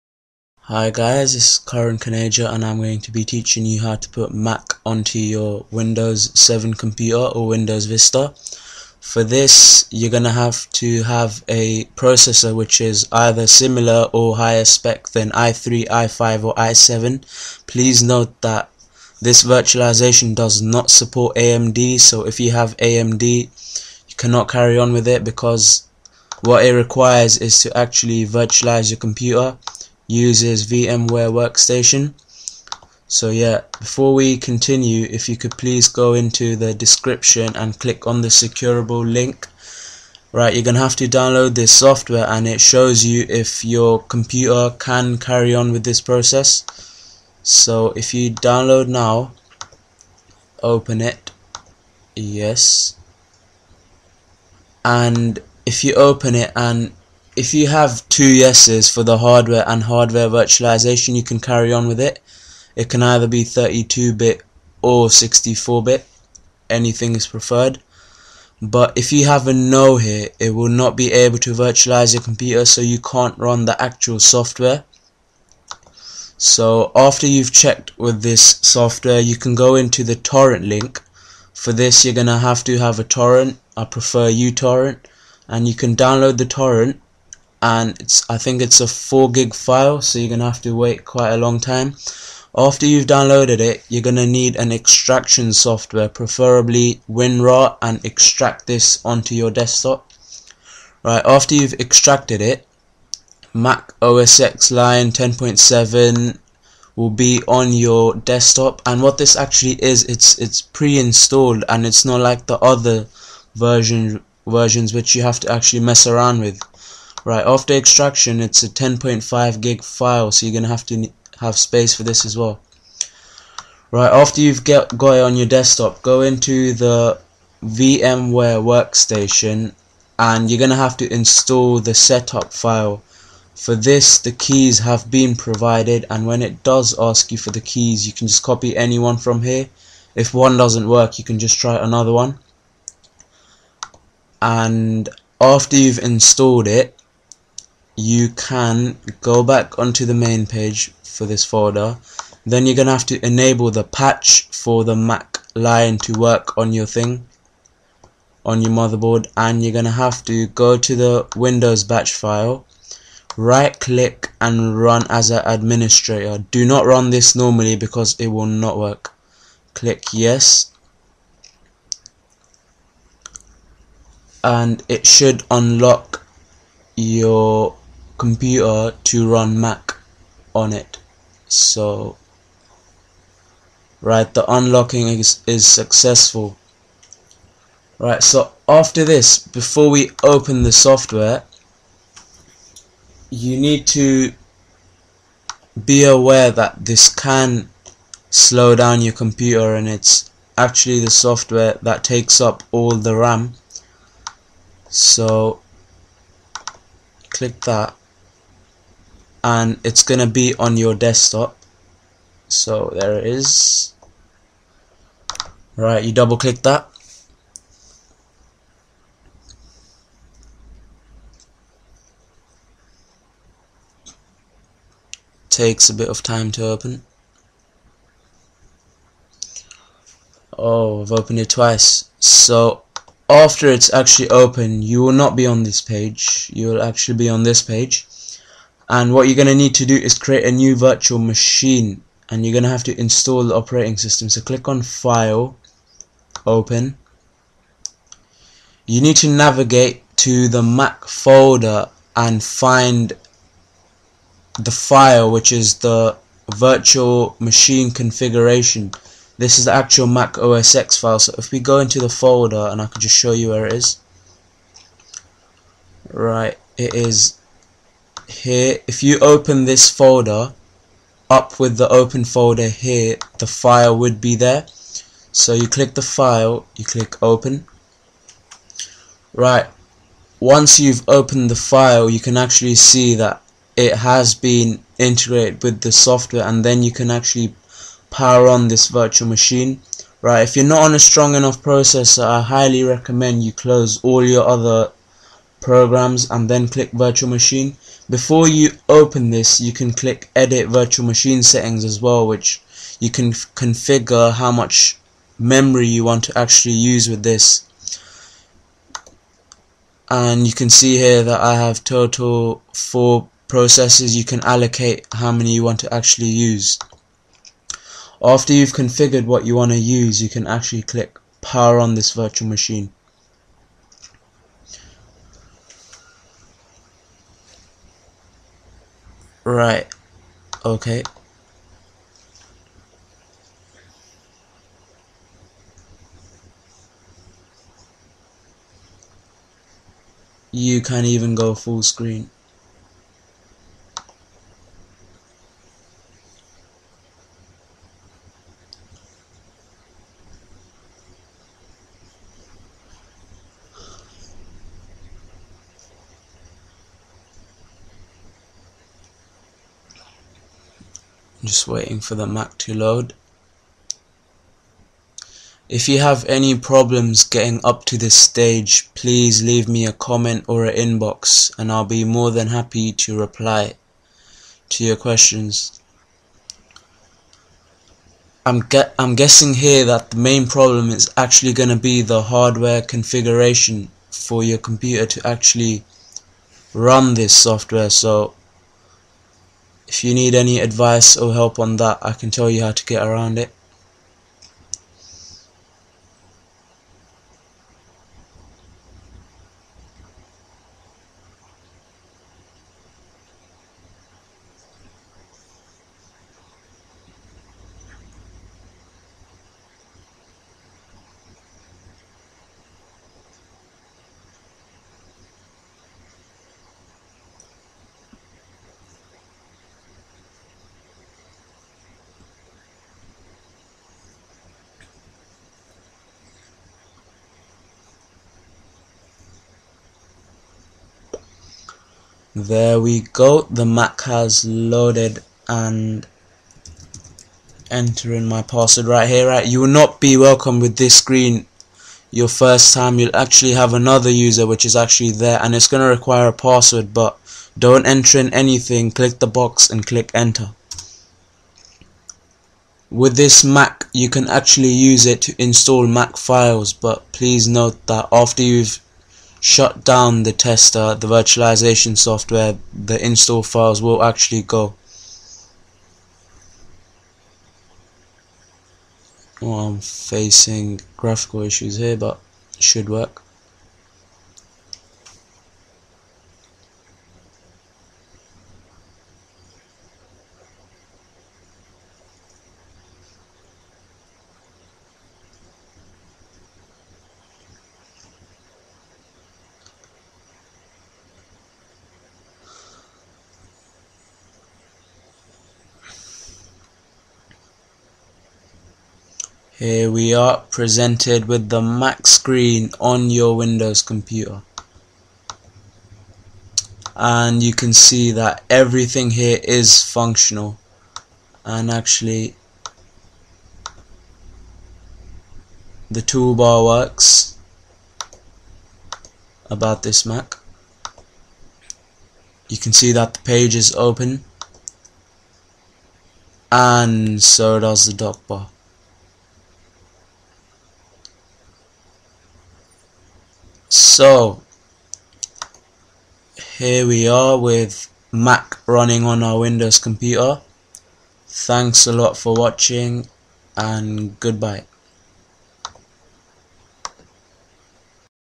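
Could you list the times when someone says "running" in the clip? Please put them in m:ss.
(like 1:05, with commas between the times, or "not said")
8:58.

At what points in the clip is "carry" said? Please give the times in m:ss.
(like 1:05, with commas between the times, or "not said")
0:24, 0:45, 1:01.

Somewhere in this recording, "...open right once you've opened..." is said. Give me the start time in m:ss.
4:37.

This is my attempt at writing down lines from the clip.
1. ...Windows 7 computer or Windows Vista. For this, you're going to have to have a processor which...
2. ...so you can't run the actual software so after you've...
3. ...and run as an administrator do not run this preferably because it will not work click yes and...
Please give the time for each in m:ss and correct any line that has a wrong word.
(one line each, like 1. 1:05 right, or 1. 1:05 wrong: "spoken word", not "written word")
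1. 0:05 right
2. 1:12 right
3. 2:44 wrong: "normally", not "preferably".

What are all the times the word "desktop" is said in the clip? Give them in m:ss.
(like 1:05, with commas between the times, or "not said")
1:39, 1:48, 2:05, 3:30.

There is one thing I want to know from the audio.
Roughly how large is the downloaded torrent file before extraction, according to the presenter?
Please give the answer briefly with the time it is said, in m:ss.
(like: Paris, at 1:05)
4 gig, at 1:28.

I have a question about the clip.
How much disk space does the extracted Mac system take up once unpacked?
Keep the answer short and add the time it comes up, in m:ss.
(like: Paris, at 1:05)
10.5 gig, at 1:58.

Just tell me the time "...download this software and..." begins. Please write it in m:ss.
0:41.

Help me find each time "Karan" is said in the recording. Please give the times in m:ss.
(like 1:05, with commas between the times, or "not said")
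0:01.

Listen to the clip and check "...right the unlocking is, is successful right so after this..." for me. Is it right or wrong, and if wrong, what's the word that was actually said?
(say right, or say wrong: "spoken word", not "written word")
right.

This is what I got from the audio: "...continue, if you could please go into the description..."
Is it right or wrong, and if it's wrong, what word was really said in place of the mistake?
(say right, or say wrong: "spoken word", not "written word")
right.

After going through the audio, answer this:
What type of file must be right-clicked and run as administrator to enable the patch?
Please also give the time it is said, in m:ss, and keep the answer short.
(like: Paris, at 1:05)
Windows batch file, at 2:41.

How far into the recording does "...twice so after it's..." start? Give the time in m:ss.
3:51.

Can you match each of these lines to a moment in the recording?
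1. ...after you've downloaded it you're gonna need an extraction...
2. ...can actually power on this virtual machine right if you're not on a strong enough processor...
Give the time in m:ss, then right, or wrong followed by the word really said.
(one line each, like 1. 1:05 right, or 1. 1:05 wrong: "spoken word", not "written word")
1. 1:32 right
2. 4:46 right.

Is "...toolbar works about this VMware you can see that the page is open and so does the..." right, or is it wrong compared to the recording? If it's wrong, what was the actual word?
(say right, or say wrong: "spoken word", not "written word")
wrong: "Mac", not "VMware".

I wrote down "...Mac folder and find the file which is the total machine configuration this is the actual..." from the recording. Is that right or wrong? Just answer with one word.
wrong.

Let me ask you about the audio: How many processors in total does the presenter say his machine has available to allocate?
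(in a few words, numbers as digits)
4.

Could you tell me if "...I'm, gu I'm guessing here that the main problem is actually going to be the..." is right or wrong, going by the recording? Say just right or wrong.
right.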